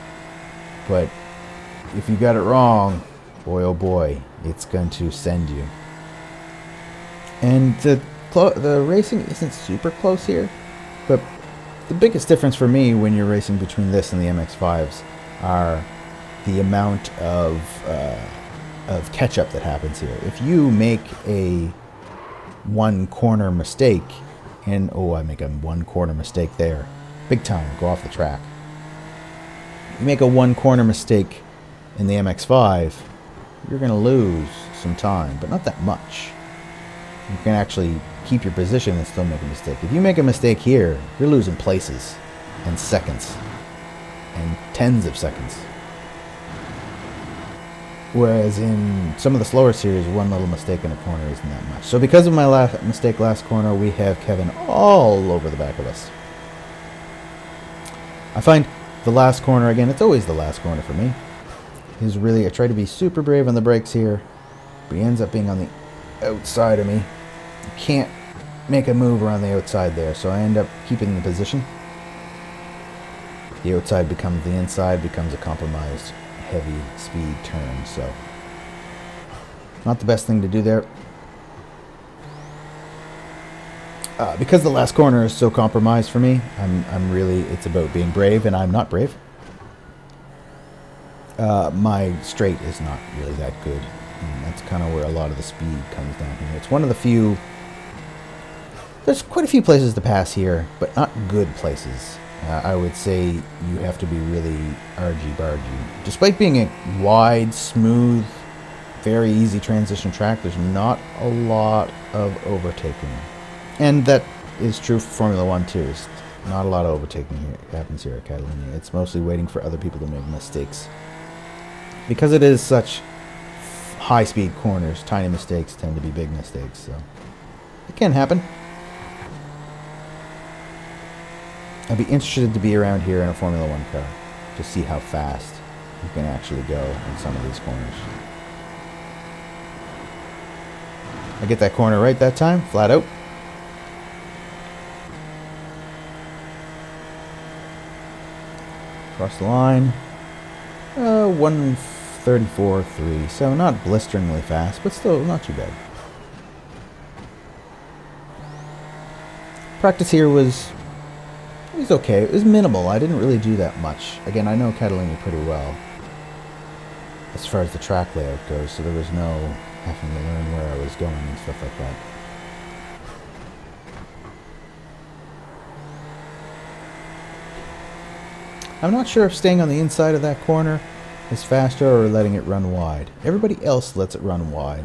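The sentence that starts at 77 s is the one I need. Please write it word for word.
So not the best thing to do there.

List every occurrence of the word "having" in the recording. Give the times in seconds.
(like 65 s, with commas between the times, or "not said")
169 s.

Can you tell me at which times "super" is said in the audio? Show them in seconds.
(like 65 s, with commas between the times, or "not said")
9 s, 62 s.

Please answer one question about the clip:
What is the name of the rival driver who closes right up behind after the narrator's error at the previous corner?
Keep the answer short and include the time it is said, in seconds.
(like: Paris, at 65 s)
Kevin, at 54 s.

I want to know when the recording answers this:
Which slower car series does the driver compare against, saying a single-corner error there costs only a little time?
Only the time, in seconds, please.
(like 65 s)
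14 s.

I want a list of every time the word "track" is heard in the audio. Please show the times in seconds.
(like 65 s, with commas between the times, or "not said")
28 s, 110 s, 167 s.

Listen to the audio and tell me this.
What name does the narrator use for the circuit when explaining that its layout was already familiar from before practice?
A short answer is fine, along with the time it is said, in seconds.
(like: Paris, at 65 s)
Catalina, at 164 s.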